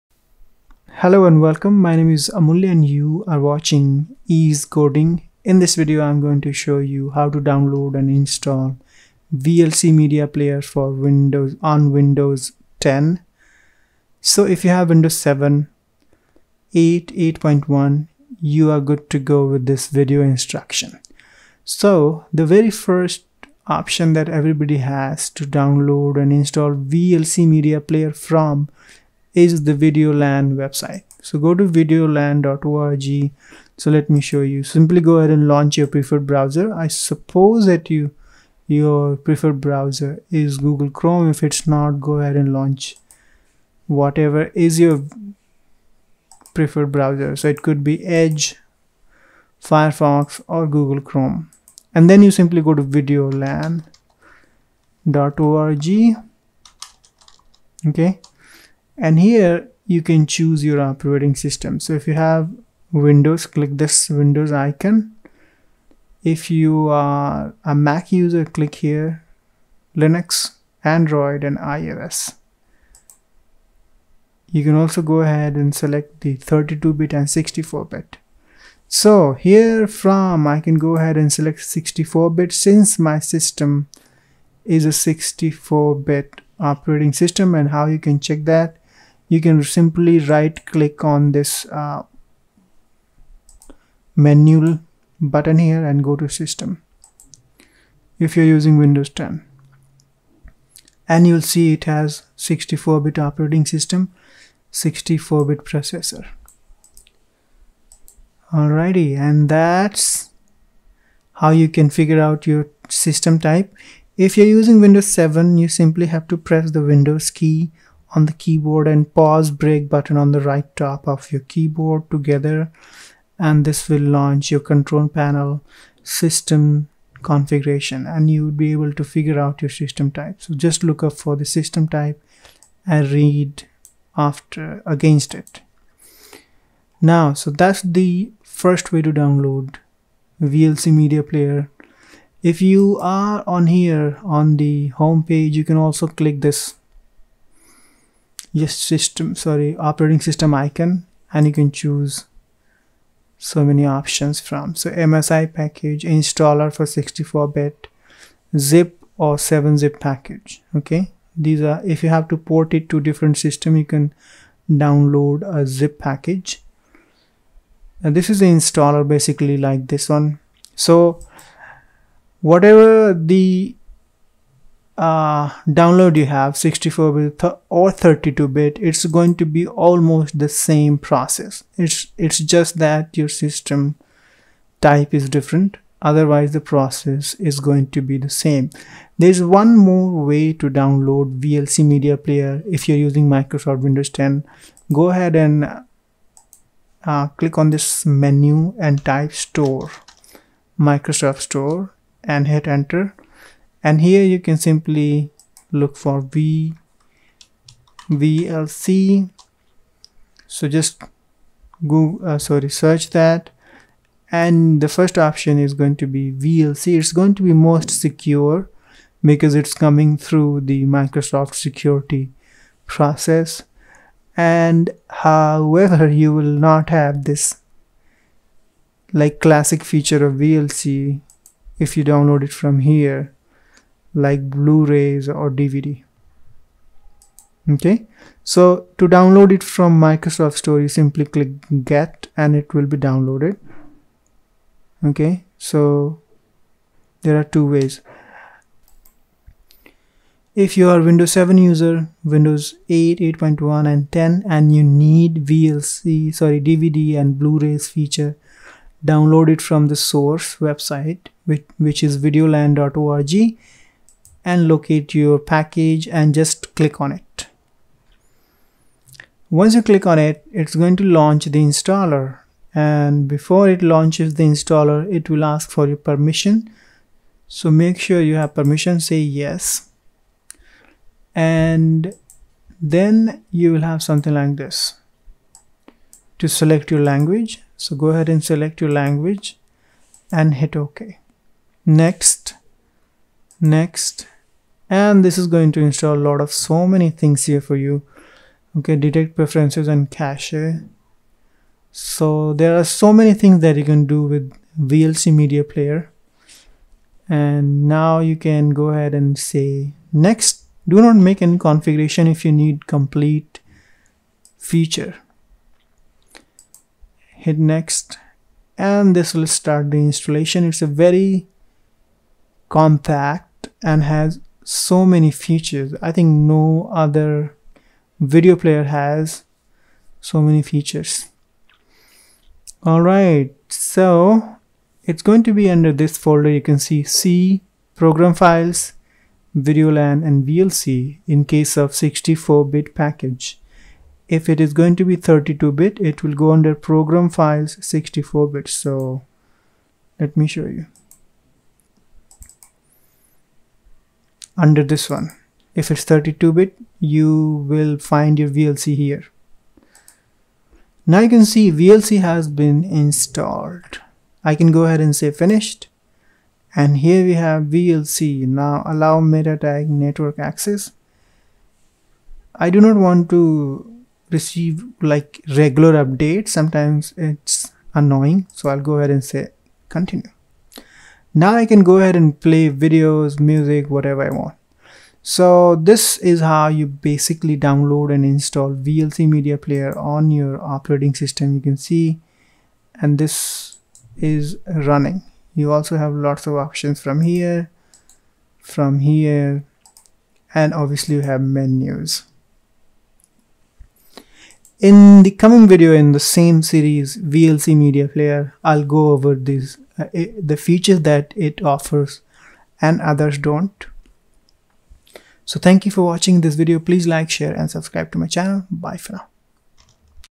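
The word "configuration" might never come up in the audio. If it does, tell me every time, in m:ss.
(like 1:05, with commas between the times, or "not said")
2:07, 5:11.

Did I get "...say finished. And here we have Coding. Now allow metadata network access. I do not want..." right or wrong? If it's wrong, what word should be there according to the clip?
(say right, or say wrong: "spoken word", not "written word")
wrong: "VLC", not "Coding".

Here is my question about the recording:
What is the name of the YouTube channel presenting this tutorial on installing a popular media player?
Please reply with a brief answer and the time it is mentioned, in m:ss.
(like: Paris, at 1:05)
Ease Coding, at 0:04.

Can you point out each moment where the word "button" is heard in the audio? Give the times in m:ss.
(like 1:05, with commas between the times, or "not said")
1:35, 1:59.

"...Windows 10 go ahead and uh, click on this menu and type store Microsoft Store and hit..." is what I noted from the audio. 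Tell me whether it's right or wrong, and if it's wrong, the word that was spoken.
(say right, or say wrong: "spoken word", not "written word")
right.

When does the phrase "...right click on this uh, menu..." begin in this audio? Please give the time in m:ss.
1:30.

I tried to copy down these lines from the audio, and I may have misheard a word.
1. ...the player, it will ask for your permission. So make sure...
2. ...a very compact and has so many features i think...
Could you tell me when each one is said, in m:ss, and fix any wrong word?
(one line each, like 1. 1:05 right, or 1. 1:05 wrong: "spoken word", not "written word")
1. 4:34 wrong: "installer", not "player"
2. 5:20 right.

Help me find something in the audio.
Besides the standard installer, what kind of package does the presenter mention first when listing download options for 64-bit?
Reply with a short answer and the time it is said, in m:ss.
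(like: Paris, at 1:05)
MSI package, at 2:34.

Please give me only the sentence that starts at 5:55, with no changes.
If it's 32-bit, you will find your VLC here.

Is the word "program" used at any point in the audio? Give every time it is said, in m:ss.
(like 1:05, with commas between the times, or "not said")
5:37, 5:46.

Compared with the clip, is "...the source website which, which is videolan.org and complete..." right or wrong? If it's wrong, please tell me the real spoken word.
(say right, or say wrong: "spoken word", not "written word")
wrong: "locate", not "complete".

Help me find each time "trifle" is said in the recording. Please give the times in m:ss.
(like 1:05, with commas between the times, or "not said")
not said.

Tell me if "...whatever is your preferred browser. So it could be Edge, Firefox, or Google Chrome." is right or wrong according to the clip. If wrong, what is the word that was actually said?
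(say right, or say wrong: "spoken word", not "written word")
right.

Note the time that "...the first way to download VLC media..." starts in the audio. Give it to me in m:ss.
2:17.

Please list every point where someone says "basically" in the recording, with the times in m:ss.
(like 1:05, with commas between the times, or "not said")
2:49, 6:26.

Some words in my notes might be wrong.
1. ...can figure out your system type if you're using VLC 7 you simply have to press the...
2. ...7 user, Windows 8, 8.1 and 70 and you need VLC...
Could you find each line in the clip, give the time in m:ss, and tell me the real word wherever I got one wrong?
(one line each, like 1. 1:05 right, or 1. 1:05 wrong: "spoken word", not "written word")
1. 1:51 wrong: "Windows", not "VLC"
2. 4:11 wrong: "10", not "70".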